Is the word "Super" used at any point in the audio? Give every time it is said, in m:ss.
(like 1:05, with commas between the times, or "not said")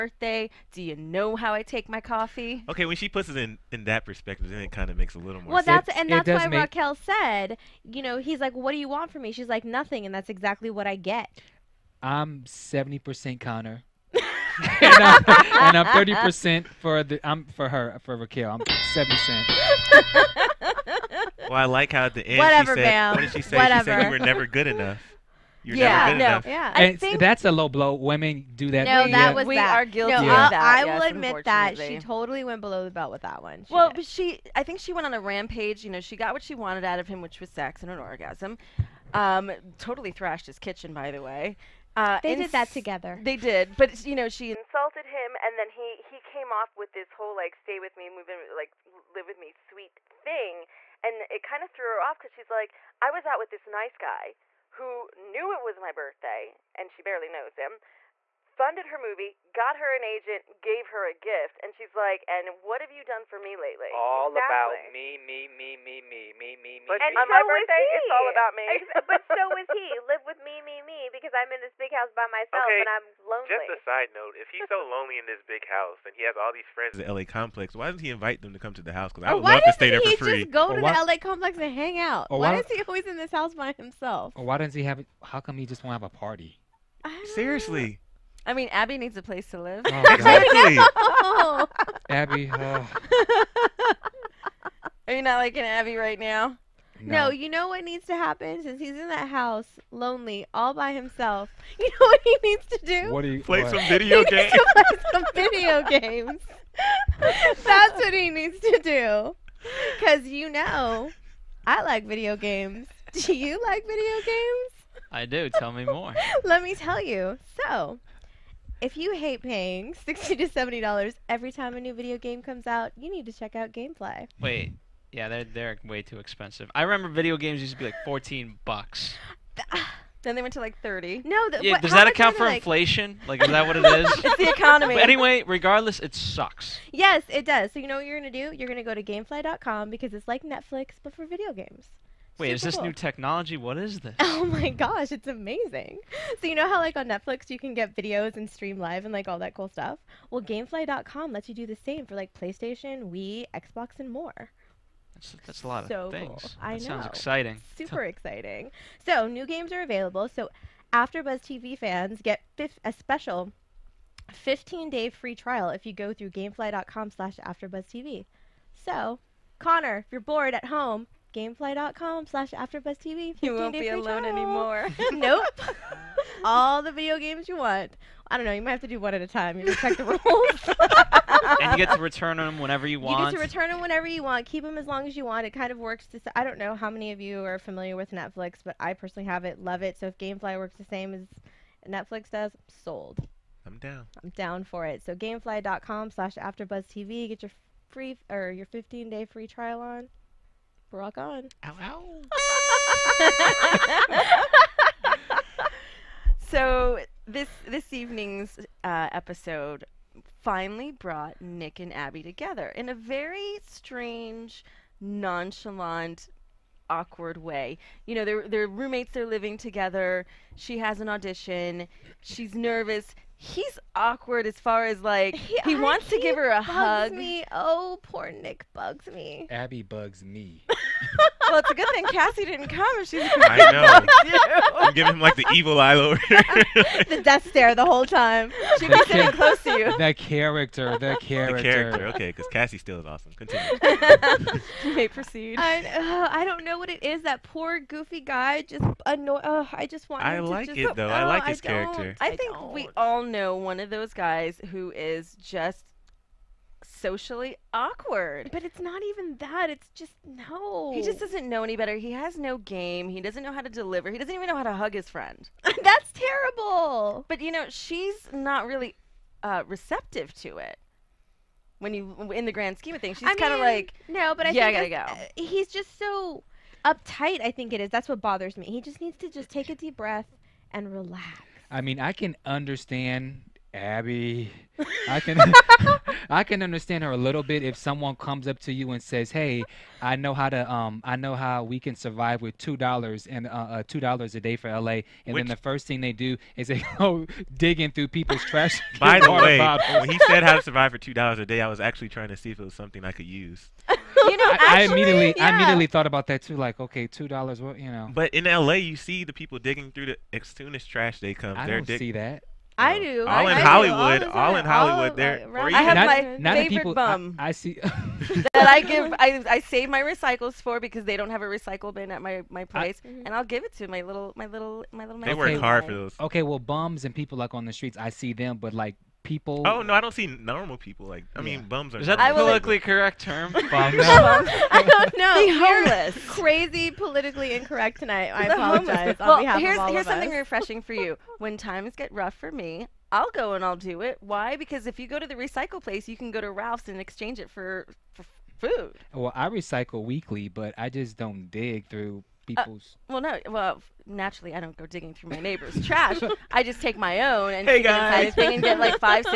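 2:22, 2:37.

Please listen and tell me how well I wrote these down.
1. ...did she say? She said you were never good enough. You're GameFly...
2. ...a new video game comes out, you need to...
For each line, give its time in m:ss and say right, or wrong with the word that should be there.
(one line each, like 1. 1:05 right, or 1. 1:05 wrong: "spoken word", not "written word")
1. 0:23 wrong: "Yeah", not "GameFly"
2. 2:01 right.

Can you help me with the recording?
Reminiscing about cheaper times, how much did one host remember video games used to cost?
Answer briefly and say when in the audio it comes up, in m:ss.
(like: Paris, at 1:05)
$14, at 2:08.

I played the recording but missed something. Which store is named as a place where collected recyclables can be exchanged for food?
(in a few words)
Ralph's.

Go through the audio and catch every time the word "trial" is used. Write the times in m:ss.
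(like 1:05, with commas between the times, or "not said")
2:45, 2:54, 3:19.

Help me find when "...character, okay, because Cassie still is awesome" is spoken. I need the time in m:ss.
4:01.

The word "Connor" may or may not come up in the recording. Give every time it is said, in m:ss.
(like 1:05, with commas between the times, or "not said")
0:13, 2:49.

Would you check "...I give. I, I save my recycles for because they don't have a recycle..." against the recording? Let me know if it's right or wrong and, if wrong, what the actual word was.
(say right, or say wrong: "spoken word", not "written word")
right.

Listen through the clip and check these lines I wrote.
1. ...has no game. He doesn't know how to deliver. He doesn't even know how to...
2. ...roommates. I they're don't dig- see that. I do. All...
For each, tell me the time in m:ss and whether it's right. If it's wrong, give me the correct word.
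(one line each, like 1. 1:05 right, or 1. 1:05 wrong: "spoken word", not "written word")
1. 4:22 right
2. 5:11 wrong: "comes", not "roommates".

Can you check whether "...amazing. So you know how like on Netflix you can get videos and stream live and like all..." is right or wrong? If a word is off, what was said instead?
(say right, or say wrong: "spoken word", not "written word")
right.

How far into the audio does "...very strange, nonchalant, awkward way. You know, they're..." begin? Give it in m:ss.
3:32.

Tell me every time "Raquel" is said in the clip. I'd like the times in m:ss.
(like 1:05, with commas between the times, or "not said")
0:06, 0:18.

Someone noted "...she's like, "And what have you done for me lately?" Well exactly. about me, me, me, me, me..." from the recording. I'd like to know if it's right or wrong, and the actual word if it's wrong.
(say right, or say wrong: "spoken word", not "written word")
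wrong: "All", not "Well".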